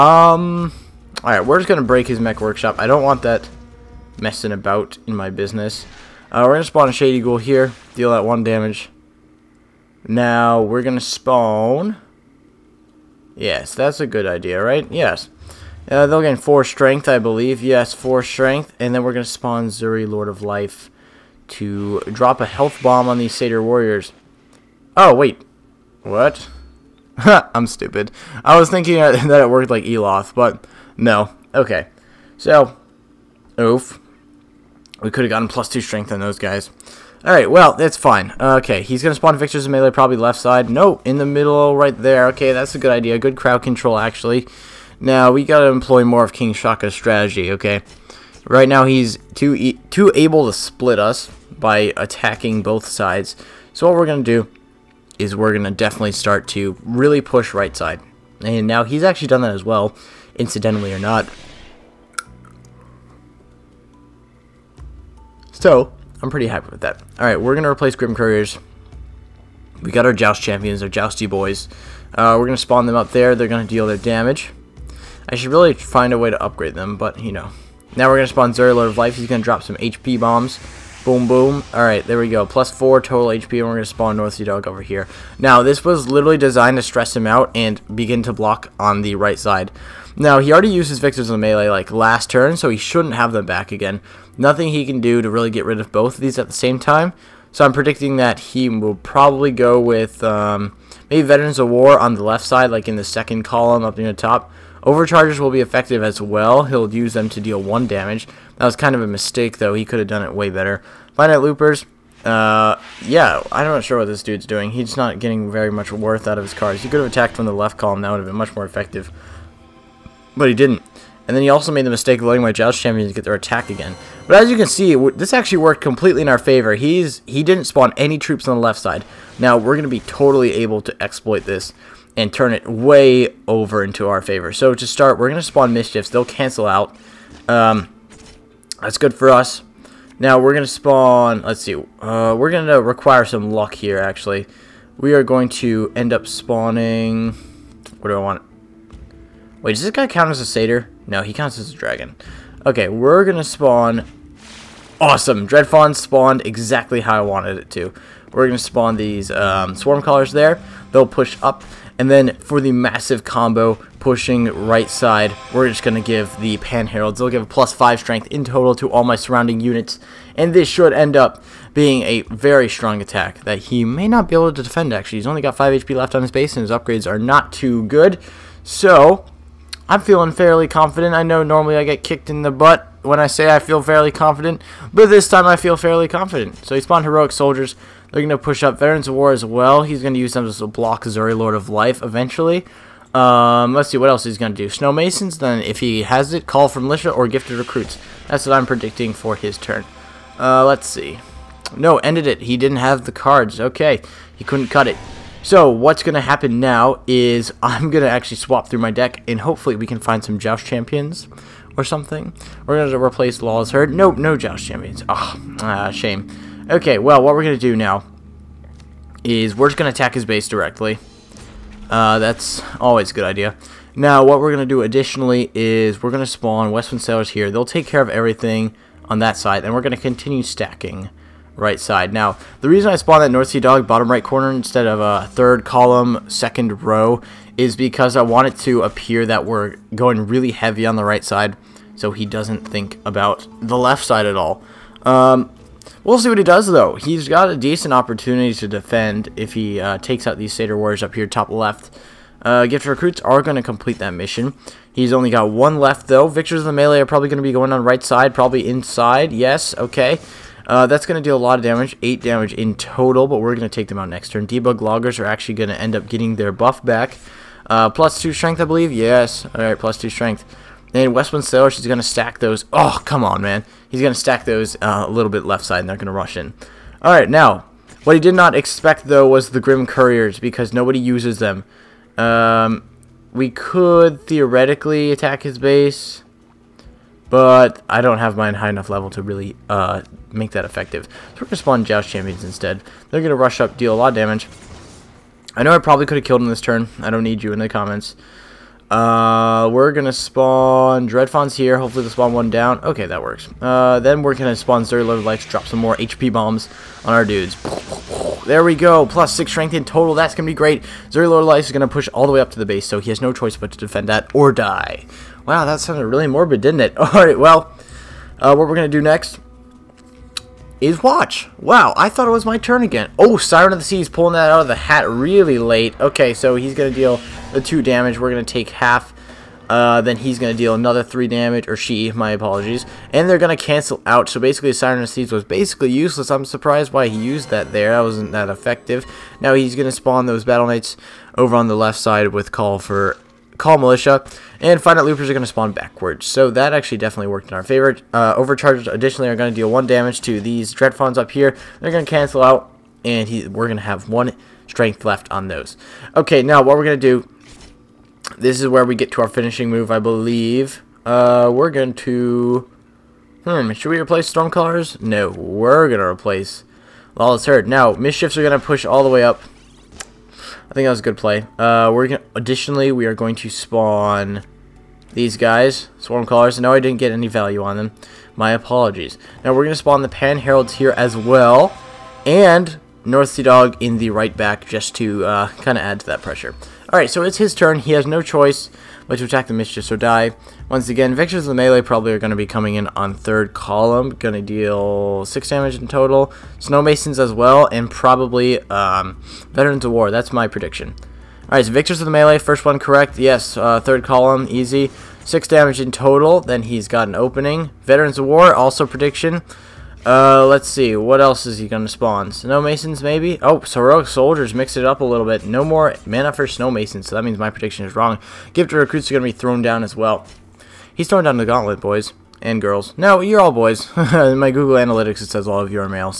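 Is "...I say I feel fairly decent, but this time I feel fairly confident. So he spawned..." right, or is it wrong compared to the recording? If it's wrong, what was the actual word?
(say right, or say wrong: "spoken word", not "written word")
wrong: "confident", not "decent".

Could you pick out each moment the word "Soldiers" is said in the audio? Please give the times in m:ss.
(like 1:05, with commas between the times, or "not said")
3:07, 6:54.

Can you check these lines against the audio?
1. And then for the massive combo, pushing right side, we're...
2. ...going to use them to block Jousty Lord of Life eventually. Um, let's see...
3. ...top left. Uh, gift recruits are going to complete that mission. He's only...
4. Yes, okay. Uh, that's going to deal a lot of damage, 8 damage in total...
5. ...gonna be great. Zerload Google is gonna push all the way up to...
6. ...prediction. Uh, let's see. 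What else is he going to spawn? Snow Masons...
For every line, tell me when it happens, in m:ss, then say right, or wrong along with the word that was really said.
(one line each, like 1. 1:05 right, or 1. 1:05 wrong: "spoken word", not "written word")
1. 2:42 right
2. 3:10 wrong: "Xuri", not "Jousty"
3. 4:11 right
4. 4:19 right
5. 5:10 wrong: "Lights", not "Google"
6. 6:48 right.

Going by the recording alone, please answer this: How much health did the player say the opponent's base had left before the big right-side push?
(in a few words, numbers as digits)
5 HP.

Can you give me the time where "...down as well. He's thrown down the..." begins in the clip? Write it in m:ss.
6:59.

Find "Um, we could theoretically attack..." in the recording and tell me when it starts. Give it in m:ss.
4:42.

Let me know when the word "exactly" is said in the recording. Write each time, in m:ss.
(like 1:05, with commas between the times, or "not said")
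2:36.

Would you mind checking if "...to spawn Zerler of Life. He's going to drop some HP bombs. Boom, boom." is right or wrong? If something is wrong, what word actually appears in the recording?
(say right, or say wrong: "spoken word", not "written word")
right.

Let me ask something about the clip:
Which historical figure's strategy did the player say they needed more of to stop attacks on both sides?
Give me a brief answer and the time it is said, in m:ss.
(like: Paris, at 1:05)
King Shaka, at 0:46.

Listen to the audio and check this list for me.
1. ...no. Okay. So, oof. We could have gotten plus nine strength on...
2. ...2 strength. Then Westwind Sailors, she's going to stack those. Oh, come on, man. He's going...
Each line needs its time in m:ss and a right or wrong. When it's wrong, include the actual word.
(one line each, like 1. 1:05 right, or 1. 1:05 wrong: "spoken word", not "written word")
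1. 0:30 wrong: "two", not "nine"
2. 4:29 right.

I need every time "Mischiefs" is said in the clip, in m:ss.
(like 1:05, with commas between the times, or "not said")
2:15, 6:07, 6:29.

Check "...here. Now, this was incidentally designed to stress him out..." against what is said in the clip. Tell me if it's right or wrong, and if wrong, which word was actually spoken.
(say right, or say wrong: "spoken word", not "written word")
wrong: "literally", not "incidentally".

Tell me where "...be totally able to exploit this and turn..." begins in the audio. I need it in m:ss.
2:09.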